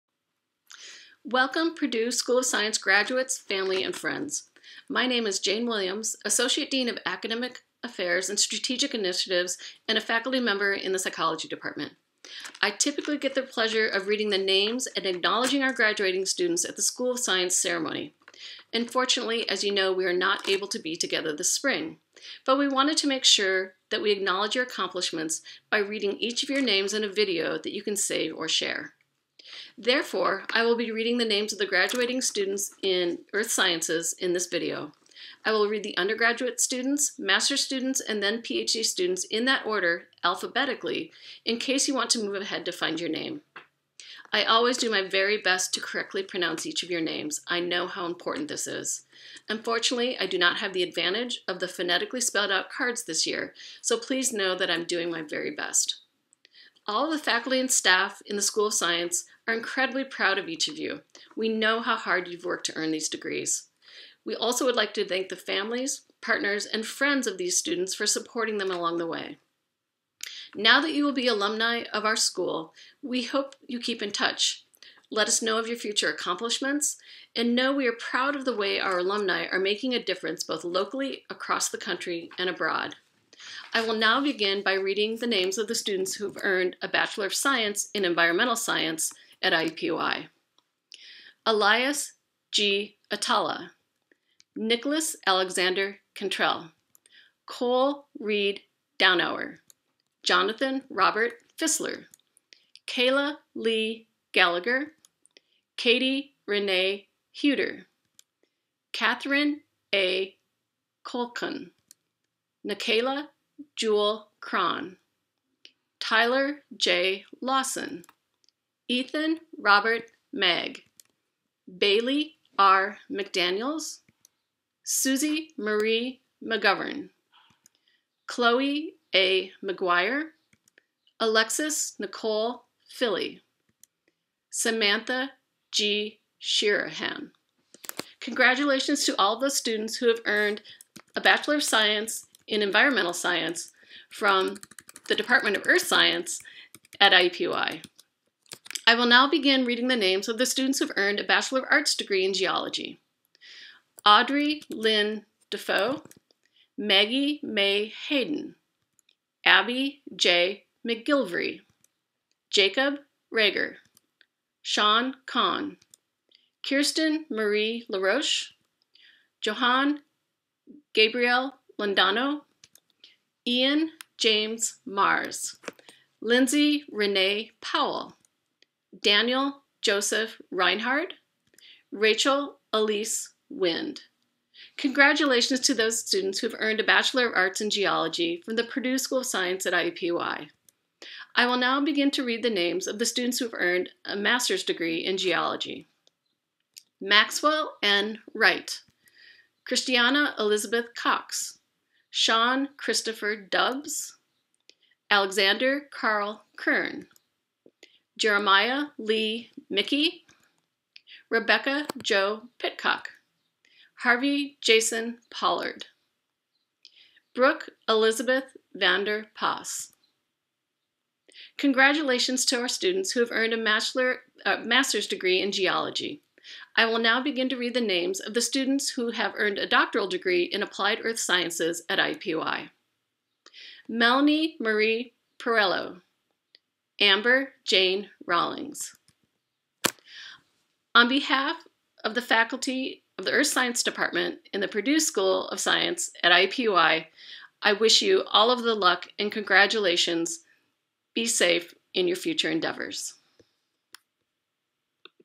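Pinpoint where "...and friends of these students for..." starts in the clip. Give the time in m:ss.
1:06.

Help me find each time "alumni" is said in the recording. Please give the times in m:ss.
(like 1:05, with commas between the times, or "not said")
1:11, 1:18.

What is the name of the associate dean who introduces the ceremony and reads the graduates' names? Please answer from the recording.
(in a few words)
Jane Williams.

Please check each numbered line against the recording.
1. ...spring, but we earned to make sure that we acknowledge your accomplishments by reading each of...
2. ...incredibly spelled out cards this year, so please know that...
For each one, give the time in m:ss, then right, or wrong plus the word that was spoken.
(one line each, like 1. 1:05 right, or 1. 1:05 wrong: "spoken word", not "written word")
1. 0:21 wrong: "wanted", not "earned"
2. 0:51 wrong: "phonetically", not "incredibly".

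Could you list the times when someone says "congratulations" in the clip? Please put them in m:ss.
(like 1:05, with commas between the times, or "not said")
2:18, 3:04, 3:41, 4:09.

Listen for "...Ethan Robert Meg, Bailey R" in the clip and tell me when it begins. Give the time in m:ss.
1:58.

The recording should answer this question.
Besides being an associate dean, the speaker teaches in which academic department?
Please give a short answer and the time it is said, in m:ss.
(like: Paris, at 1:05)
Psychology, at 0:10.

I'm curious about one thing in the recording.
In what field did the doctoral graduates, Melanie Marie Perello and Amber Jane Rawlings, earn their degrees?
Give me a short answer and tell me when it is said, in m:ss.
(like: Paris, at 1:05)
Applied Earth Sciences, at 3:50.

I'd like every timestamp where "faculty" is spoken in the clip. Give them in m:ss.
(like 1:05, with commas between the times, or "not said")
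0:10, 0:57, 4:02.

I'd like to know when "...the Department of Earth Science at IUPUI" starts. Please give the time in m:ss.
2:25.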